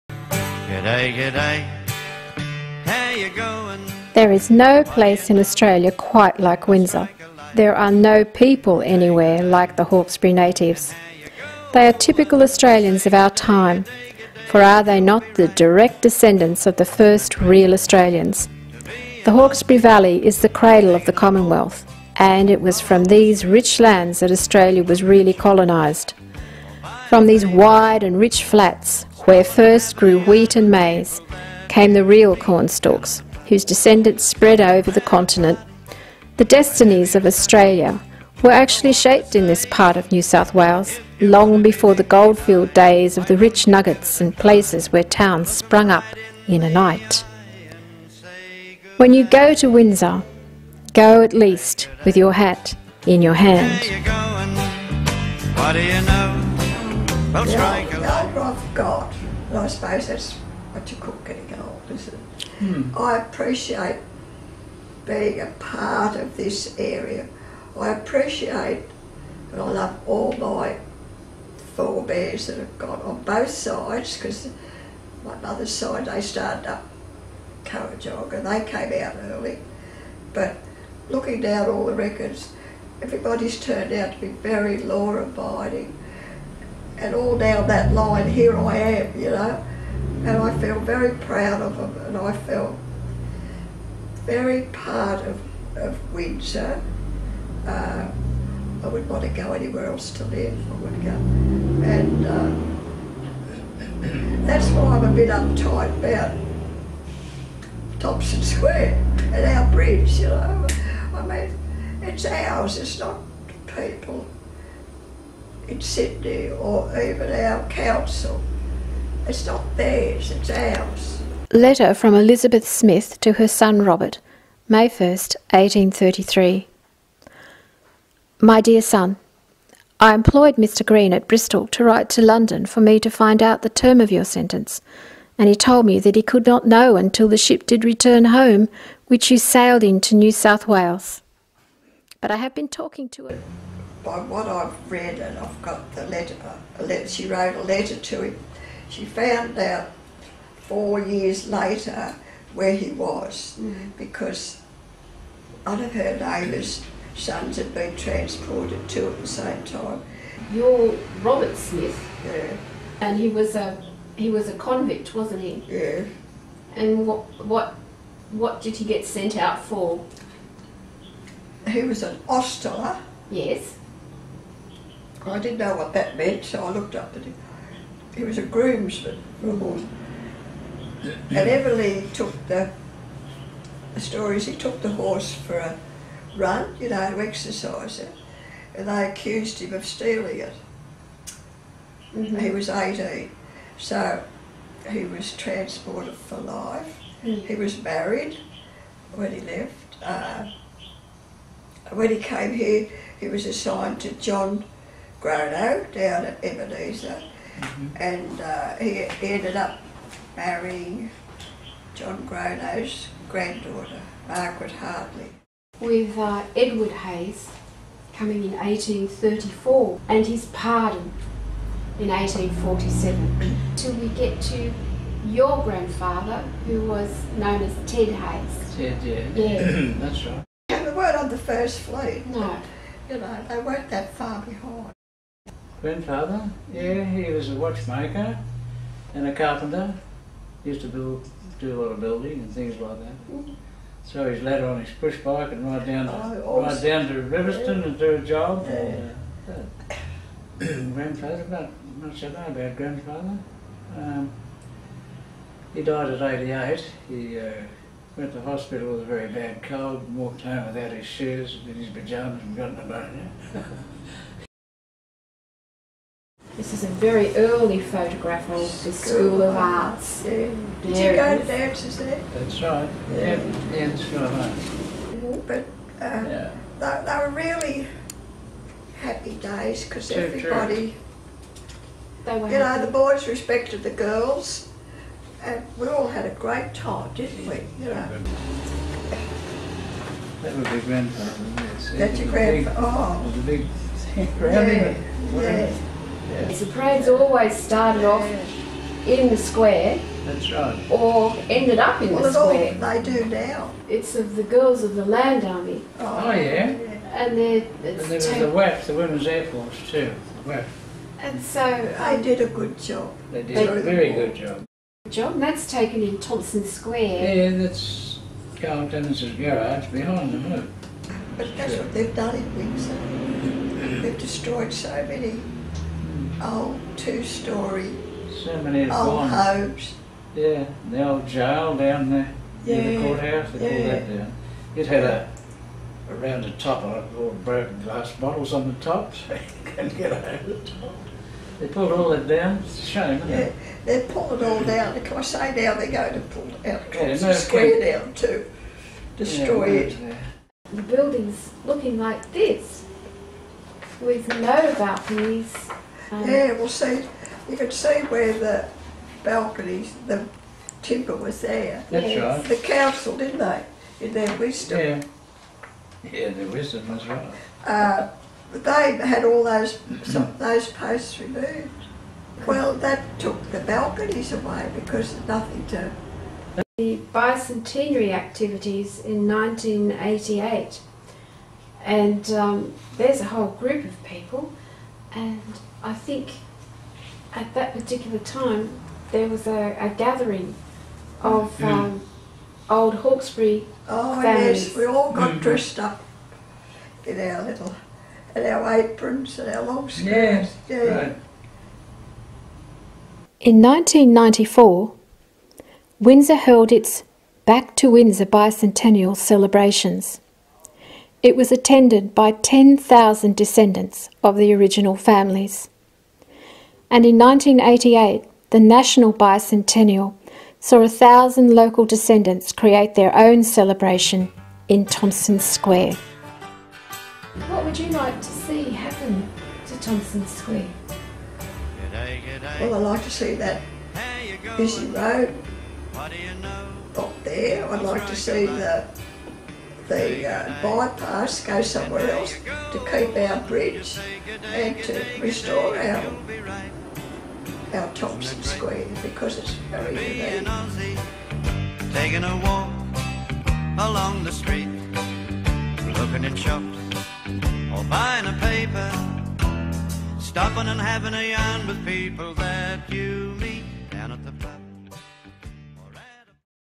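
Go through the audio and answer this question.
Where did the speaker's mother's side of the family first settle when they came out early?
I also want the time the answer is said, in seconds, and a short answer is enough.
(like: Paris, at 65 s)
Kurrajong, at 77 s.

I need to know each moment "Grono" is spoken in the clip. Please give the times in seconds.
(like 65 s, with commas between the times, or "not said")
205 s, 212 s.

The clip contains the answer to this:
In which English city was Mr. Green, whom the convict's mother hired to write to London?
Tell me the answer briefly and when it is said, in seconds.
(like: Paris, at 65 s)
Bristol, at 131 s.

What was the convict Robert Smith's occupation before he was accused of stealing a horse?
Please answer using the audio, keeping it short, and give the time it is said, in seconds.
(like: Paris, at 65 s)
Ostler, at 172 s.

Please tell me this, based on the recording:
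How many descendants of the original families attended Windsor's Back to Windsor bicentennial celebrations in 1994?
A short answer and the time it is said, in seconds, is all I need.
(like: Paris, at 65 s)
10,000, at 412 s.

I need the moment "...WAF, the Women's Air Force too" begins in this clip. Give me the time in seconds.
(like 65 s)
308 s.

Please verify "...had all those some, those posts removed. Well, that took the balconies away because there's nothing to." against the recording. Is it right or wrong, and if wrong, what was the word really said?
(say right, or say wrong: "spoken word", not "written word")
right.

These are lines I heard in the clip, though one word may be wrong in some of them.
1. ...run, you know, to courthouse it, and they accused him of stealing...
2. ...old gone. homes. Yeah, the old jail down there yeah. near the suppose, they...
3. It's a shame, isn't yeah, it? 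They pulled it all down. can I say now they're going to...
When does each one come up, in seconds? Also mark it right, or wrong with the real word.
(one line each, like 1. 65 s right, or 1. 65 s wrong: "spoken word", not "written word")
1. 186 s wrong: "exercise", not "courthouse"
2. 328 s wrong: "courthouse", not "suppose"
3. 342 s right.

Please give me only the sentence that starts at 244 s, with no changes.
So he's later on his push bike and ride down to, oh, ride down to Riverstone and do a job.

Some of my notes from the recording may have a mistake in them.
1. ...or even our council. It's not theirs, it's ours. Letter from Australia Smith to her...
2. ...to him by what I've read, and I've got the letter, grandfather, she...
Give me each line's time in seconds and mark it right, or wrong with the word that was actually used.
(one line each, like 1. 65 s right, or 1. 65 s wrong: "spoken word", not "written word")
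1. 116 s wrong: "Elizabeth", not "Australia"
2. 143 s wrong: "letter", not "grandfather".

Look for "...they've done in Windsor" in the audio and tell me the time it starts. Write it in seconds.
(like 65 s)
321 s.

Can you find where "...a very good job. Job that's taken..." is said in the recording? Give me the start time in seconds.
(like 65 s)
313 s.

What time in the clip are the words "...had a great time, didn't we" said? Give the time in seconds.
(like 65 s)
286 s.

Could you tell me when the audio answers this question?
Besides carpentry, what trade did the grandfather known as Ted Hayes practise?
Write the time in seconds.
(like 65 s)
237 s.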